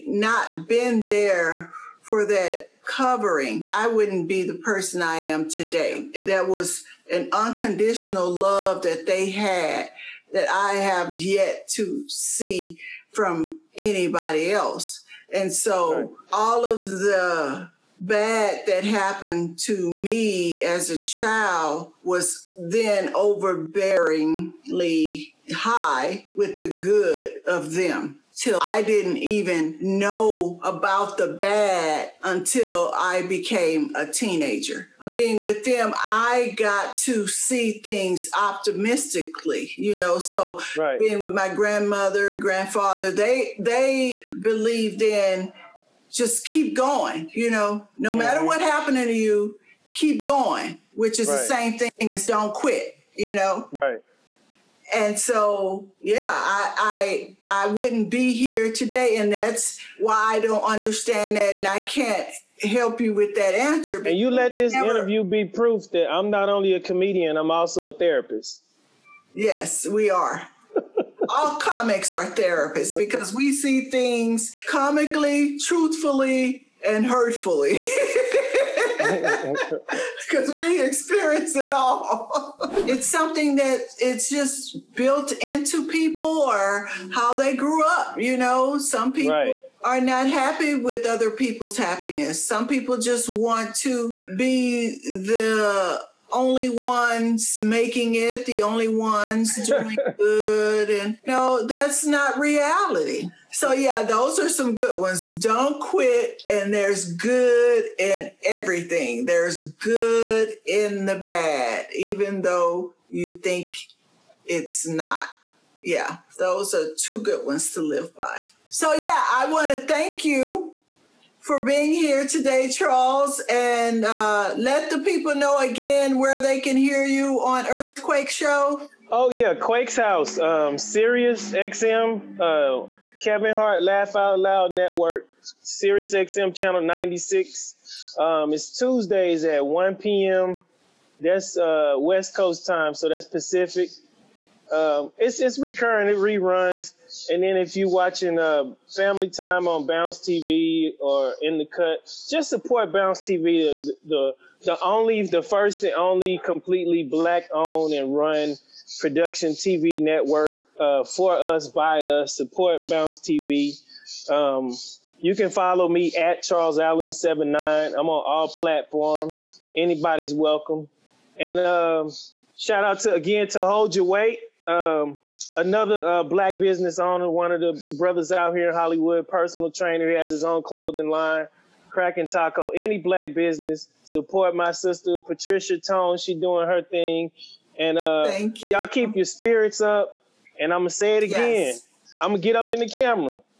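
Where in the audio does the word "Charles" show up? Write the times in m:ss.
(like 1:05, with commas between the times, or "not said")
2:02, 2:46.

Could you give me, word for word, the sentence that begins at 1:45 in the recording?
Don't quit and there's good in everything.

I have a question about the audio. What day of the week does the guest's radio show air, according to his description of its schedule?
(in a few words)
Tuesdays.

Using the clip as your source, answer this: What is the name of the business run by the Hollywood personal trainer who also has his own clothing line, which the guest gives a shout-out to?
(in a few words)
Hold Your Weight.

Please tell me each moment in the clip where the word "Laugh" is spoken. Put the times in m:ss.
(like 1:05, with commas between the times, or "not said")
2:13.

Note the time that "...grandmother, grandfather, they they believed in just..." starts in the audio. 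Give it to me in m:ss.
0:41.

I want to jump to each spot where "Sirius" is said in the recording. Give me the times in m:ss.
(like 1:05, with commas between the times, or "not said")
2:10, 2:15.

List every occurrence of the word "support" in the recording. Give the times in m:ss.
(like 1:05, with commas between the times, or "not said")
2:32, 2:42, 3:04.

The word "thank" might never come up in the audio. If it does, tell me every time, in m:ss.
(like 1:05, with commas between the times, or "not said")
1:59, 3:08.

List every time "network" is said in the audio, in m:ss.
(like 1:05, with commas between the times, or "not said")
2:14, 2:40.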